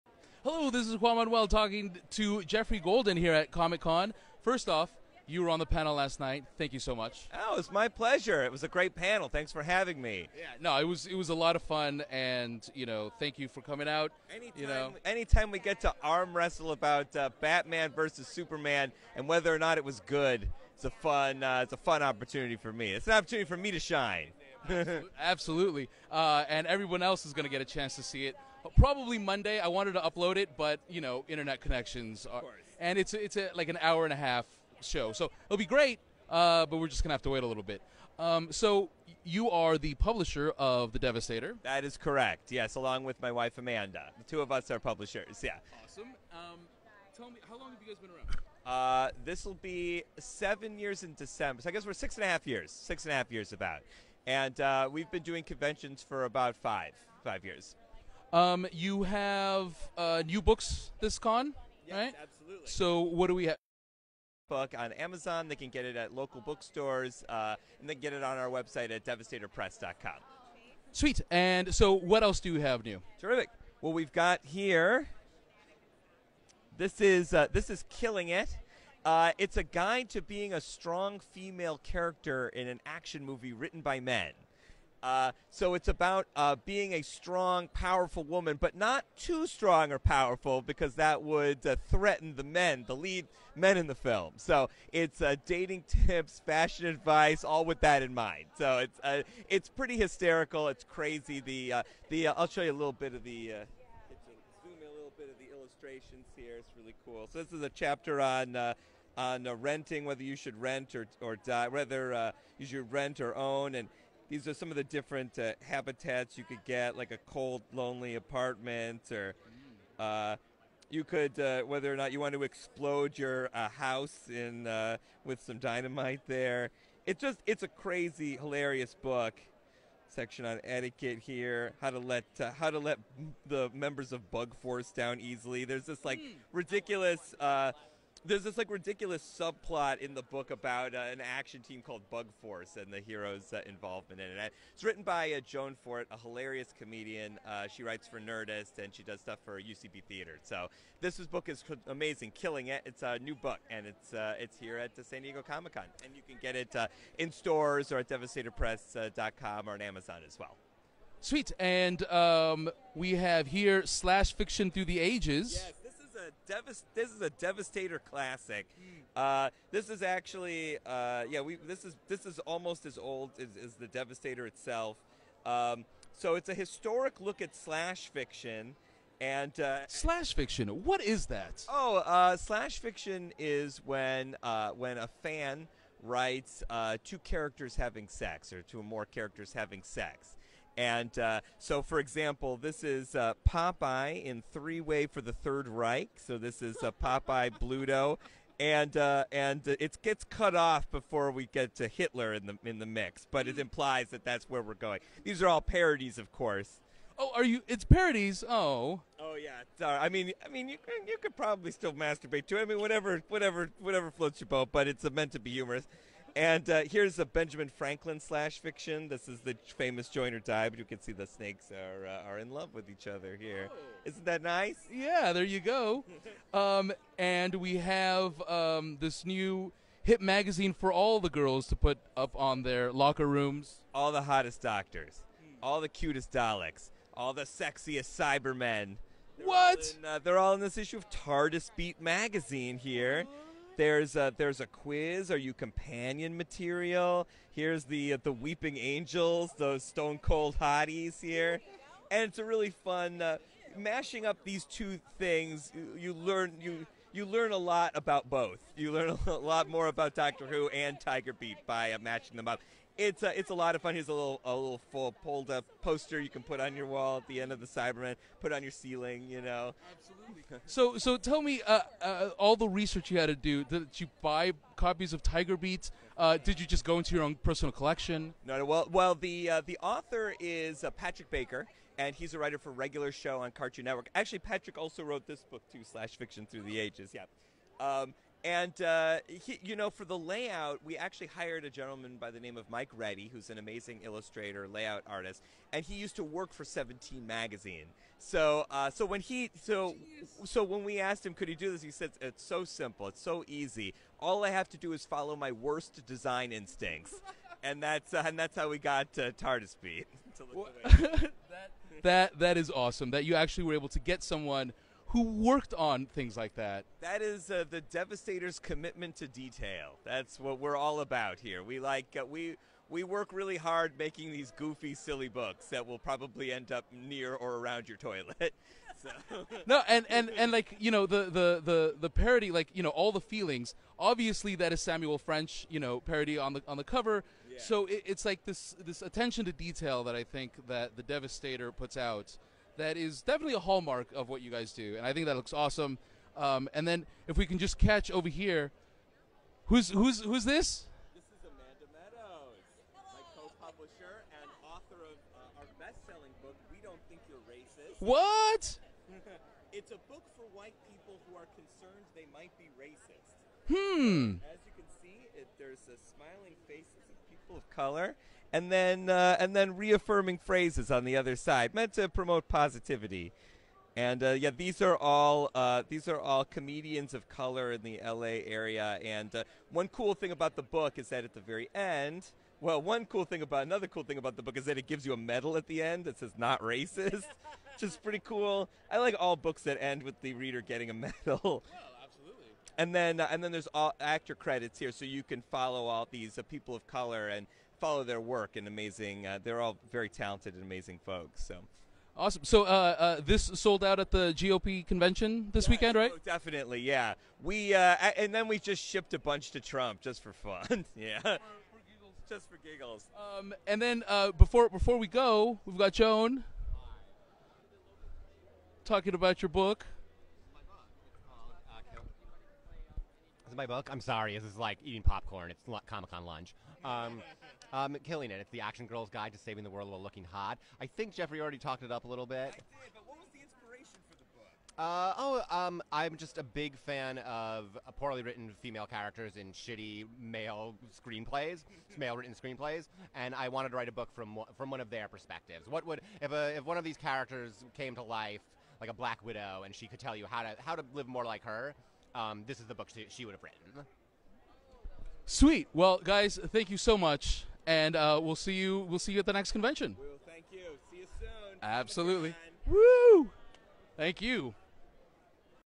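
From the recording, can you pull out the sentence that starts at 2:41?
Sweet, and um, we have here slash fiction through the ages.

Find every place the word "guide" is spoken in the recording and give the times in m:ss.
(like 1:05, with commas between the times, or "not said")
1:19, 7:09.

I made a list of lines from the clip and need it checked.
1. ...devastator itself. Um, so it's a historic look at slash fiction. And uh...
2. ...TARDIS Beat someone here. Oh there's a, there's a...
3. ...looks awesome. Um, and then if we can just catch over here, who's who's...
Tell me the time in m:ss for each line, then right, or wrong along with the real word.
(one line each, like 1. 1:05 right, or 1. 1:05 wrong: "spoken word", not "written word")
1. 2:53 right
2. 4:01 wrong: "magazine", not "someone"
3. 5:45 right.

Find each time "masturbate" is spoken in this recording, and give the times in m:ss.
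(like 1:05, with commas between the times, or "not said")
3:31.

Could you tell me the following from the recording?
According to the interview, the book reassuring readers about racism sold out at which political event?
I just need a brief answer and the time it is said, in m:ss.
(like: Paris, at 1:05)
the GOP convention, at 6:44.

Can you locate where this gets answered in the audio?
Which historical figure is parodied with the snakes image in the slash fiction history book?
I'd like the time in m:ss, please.
3:37.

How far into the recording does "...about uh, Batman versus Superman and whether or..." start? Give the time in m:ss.
0:16.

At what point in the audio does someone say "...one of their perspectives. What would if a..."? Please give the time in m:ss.
7:24.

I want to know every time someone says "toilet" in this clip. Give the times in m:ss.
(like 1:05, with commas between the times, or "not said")
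5:27.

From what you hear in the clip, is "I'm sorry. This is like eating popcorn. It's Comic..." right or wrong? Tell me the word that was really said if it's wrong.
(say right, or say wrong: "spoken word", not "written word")
right.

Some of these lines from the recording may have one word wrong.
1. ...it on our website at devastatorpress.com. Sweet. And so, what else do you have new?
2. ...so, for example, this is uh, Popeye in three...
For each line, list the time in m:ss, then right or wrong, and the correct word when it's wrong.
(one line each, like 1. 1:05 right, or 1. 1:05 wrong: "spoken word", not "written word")
1. 1:08 right
2. 3:11 right.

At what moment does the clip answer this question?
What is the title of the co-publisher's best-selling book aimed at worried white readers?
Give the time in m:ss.
5:56.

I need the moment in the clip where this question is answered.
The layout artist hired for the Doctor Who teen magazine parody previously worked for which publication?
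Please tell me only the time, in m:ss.
4:56.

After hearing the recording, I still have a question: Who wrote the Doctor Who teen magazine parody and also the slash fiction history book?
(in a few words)
Patrick Baker.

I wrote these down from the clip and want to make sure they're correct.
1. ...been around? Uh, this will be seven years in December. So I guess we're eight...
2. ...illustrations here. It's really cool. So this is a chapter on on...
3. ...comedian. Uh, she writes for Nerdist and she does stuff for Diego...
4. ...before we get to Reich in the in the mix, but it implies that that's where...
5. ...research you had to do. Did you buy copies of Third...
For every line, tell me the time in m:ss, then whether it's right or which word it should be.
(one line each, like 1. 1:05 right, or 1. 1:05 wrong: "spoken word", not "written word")
1. 0:48 wrong: "six", not "eight"
2. 1:45 right
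3. 2:26 wrong: "UCB", not "Diego"
4. 3:20 wrong: "Hitler", not "Reich"
5. 4:32 wrong: "Tiger", not "Third".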